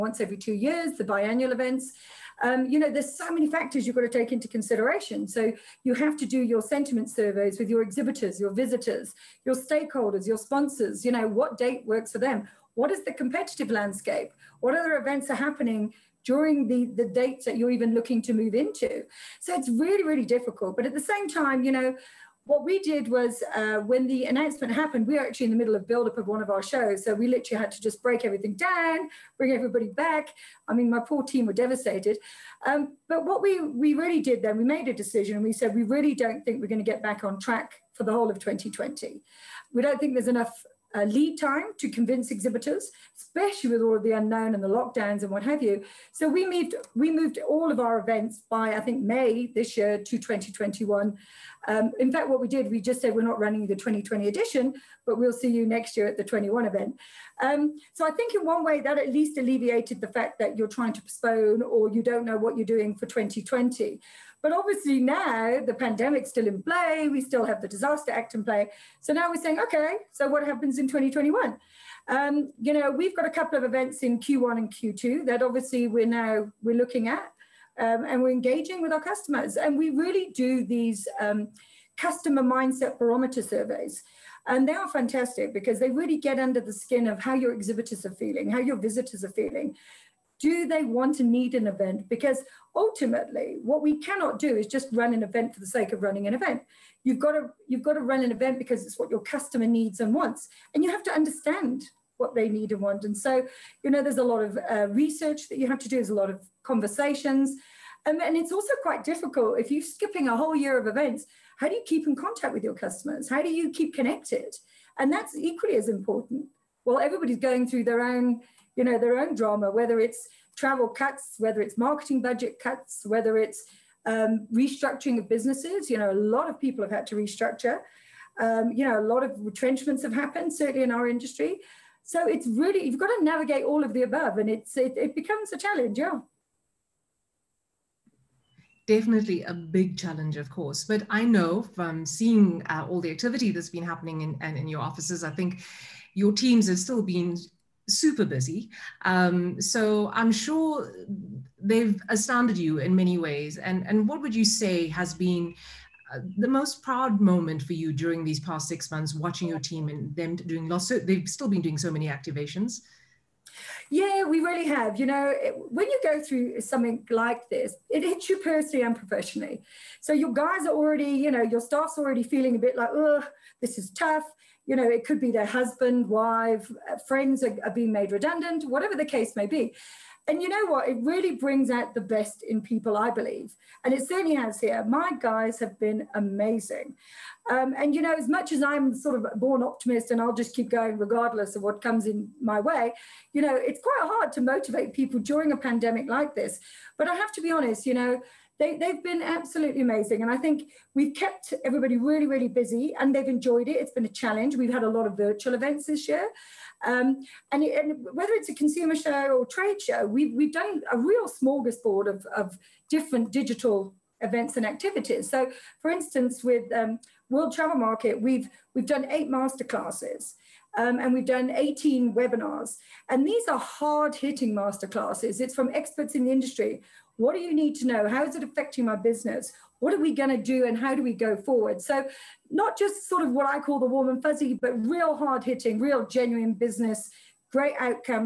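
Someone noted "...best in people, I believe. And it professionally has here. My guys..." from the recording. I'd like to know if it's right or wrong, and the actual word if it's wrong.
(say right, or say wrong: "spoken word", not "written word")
wrong: "certainly", not "professionally".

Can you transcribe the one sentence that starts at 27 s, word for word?
So we literally had to just break everything down, bring everybody back.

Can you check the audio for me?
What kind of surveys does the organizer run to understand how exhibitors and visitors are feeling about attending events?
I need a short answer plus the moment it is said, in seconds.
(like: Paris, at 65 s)
customer mindset barometer surveys, at 81 s.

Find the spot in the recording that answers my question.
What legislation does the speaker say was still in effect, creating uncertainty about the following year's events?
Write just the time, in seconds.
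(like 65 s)
67 s.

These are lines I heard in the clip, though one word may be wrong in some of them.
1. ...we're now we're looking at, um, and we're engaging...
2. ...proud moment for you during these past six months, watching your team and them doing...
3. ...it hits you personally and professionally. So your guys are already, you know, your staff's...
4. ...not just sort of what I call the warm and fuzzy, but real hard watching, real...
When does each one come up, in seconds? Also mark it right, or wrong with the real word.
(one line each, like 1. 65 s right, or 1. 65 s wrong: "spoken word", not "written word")
1. 75 s right
2. 156 s right
3. 167 s right
4. 232 s wrong: "hitting", not "watching".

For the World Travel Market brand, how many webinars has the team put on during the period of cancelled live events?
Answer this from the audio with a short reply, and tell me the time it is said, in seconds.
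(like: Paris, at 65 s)
18, at 221 s.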